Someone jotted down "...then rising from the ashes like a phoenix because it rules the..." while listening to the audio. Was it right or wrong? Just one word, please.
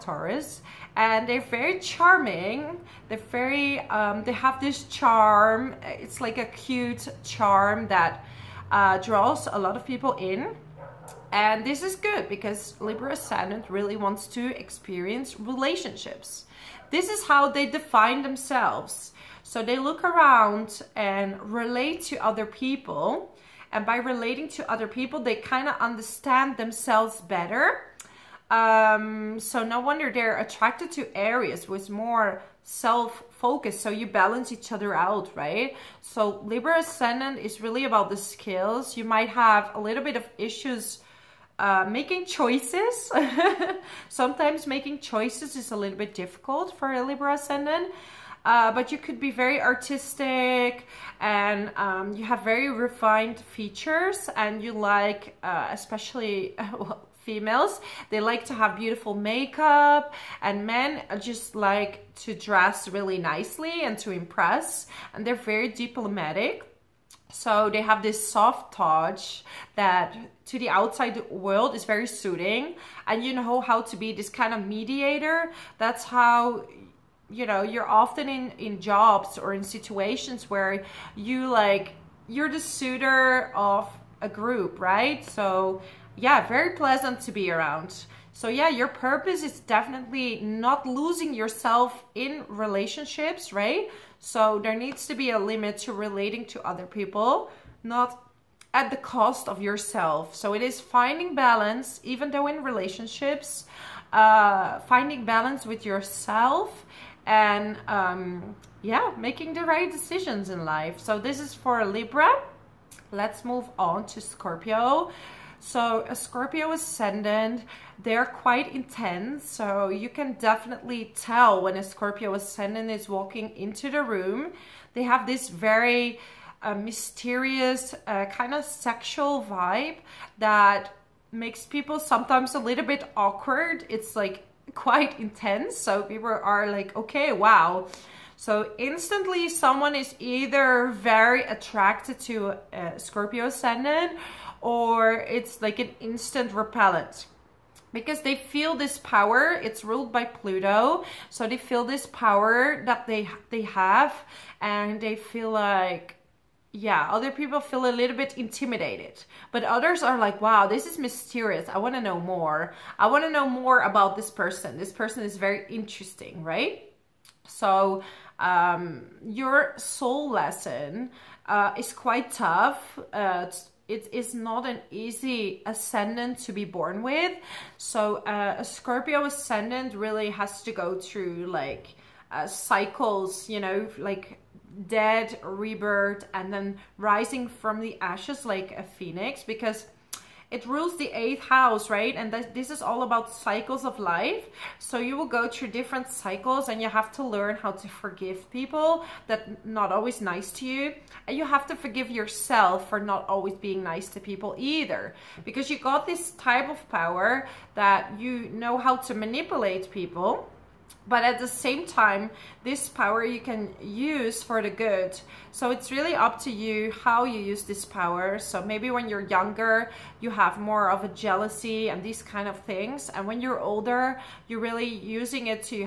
right.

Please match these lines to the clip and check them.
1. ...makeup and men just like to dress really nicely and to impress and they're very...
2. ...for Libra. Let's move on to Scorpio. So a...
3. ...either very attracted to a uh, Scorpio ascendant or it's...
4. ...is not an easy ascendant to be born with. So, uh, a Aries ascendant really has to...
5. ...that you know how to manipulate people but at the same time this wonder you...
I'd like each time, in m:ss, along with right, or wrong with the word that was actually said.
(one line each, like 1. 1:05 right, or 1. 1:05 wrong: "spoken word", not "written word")
1. 0:59 right
2. 1:51 right
3. 2:20 right
4. 2:54 wrong: "Scorpio", not "Aries"
5. 3:27 wrong: "power", not "wonder".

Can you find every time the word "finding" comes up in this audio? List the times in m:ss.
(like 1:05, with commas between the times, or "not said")
1:40, 1:44.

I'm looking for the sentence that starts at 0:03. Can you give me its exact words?
They're very, um, they have this charm.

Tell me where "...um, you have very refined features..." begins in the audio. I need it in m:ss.
0:51.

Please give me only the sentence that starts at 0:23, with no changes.
And by relating to other people, they kind of understand themselves better.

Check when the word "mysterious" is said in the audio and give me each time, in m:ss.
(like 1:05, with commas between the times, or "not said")
2:06, 2:40.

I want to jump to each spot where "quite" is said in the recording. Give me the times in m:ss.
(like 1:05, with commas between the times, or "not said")
1:58, 2:14, 2:51.